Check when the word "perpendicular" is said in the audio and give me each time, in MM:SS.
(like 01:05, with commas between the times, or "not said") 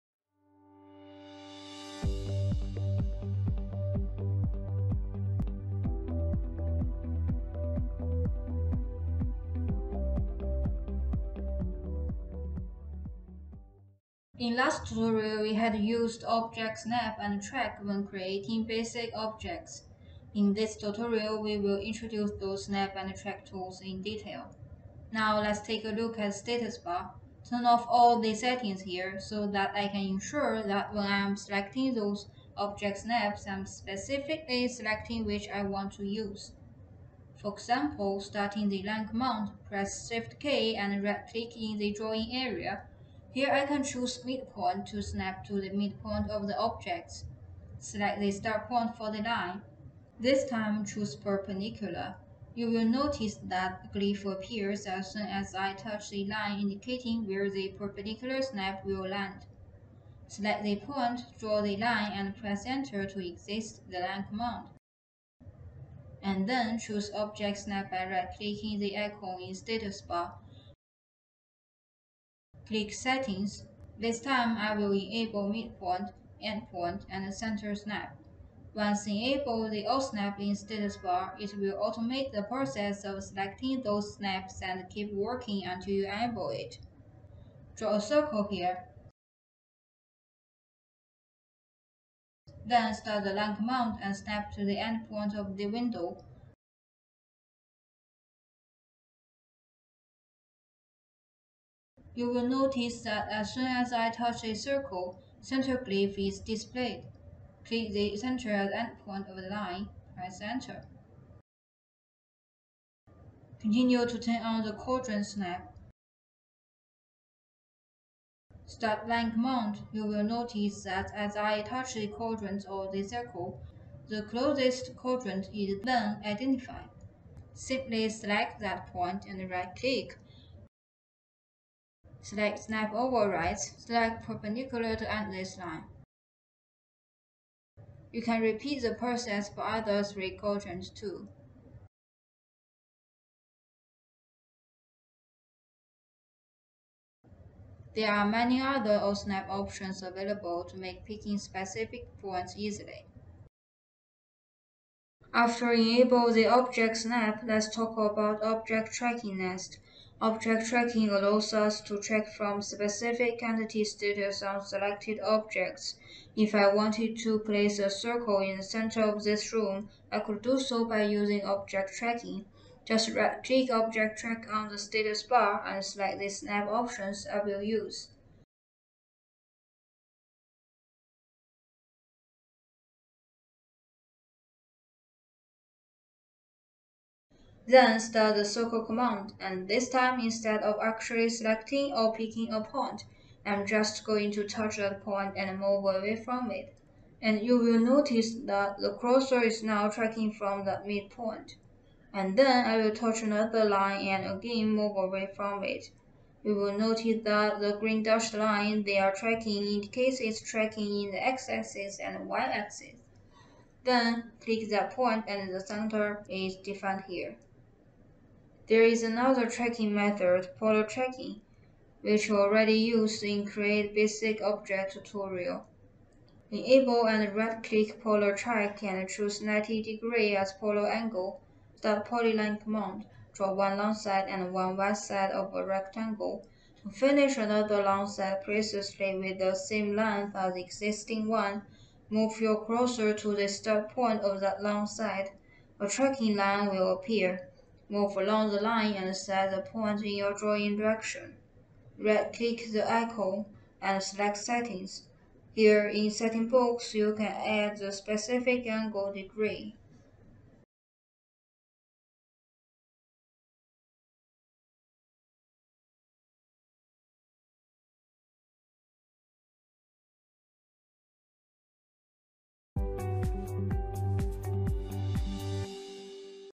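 00:51, 00:57, 02:14.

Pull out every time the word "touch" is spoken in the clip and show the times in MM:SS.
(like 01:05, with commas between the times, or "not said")
00:55, 01:44, 02:01, 03:14, 03:22.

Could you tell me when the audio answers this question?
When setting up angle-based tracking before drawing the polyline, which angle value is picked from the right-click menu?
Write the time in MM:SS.
03:49.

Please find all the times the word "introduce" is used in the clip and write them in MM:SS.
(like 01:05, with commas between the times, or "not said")
00:21.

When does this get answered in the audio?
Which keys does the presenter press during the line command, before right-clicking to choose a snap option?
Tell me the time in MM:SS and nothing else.
00:40.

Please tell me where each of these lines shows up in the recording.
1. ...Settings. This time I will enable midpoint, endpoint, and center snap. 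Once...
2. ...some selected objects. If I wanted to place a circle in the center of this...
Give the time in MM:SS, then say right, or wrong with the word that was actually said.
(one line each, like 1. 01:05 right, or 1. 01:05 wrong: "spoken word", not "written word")
1. 01:12 right
2. 02:44 right.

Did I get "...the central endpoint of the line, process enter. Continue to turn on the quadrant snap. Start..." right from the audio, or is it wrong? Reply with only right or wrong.
wrong.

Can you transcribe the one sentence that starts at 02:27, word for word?
There are many other OSNAP options available to make picking specific points easily.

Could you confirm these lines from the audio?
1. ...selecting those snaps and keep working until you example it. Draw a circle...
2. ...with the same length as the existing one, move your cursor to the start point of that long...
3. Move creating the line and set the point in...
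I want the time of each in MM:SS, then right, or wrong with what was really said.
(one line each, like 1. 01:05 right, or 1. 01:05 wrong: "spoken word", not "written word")
1. 01:23 wrong: "enable", not "example"
2. 03:59 right
3. 04:07 wrong: "along", not "creating".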